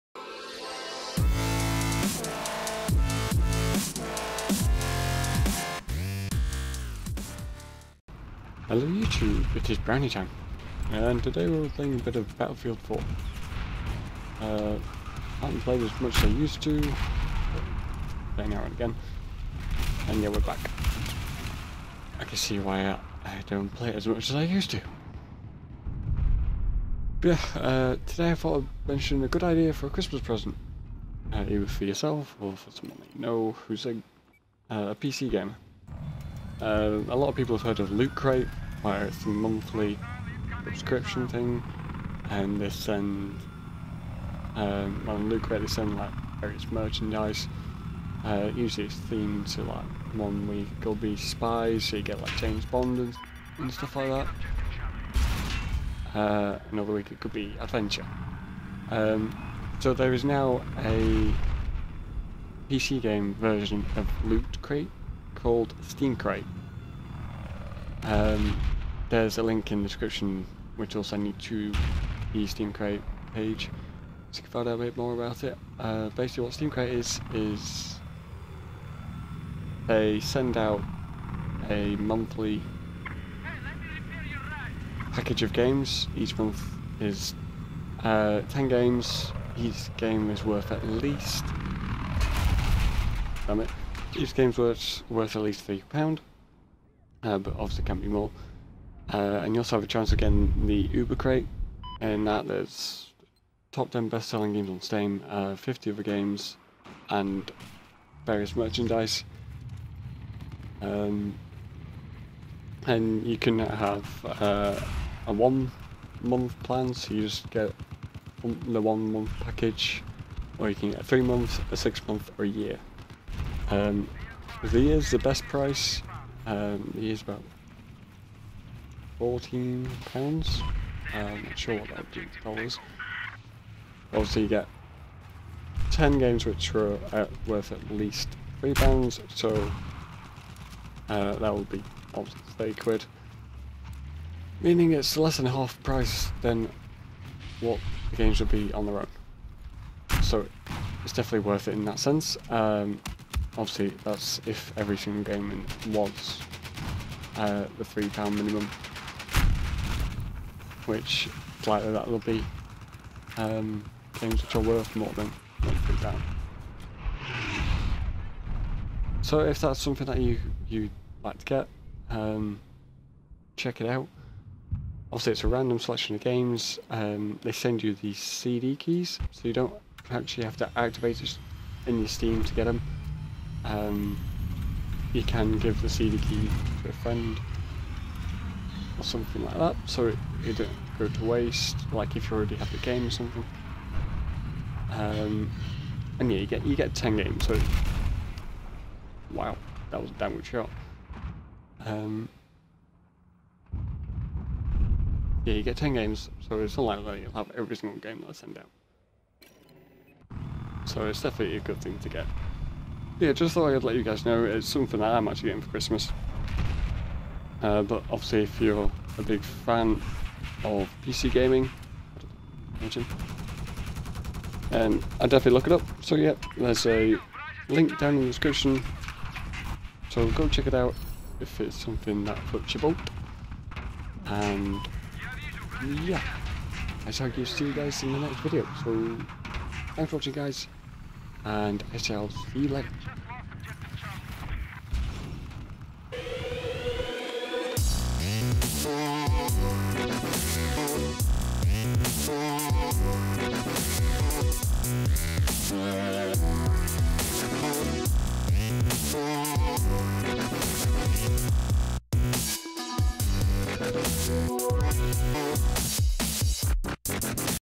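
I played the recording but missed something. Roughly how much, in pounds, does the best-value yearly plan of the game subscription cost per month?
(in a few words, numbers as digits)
£14.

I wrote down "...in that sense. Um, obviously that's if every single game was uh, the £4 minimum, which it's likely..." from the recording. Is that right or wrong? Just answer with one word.
wrong.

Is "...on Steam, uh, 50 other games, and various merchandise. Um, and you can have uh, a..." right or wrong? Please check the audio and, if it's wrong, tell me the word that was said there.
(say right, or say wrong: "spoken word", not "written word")
right.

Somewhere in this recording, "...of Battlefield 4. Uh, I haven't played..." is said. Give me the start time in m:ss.
0:12.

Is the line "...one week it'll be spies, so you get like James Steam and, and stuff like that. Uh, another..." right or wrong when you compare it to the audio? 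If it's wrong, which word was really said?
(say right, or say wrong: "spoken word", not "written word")
wrong: "Bond", not "Steam".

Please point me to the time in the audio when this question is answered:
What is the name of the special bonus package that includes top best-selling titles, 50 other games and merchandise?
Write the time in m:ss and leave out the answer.
1:40.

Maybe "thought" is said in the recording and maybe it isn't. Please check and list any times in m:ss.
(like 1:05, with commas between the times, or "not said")
0:28, 3:33.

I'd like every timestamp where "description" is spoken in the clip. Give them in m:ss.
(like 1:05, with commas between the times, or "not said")
1:09, 3:48.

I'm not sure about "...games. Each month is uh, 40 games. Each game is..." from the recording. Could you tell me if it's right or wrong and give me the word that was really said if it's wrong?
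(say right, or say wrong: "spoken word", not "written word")
wrong: "10", not "40".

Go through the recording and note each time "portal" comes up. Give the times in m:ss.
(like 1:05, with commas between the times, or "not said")
not said.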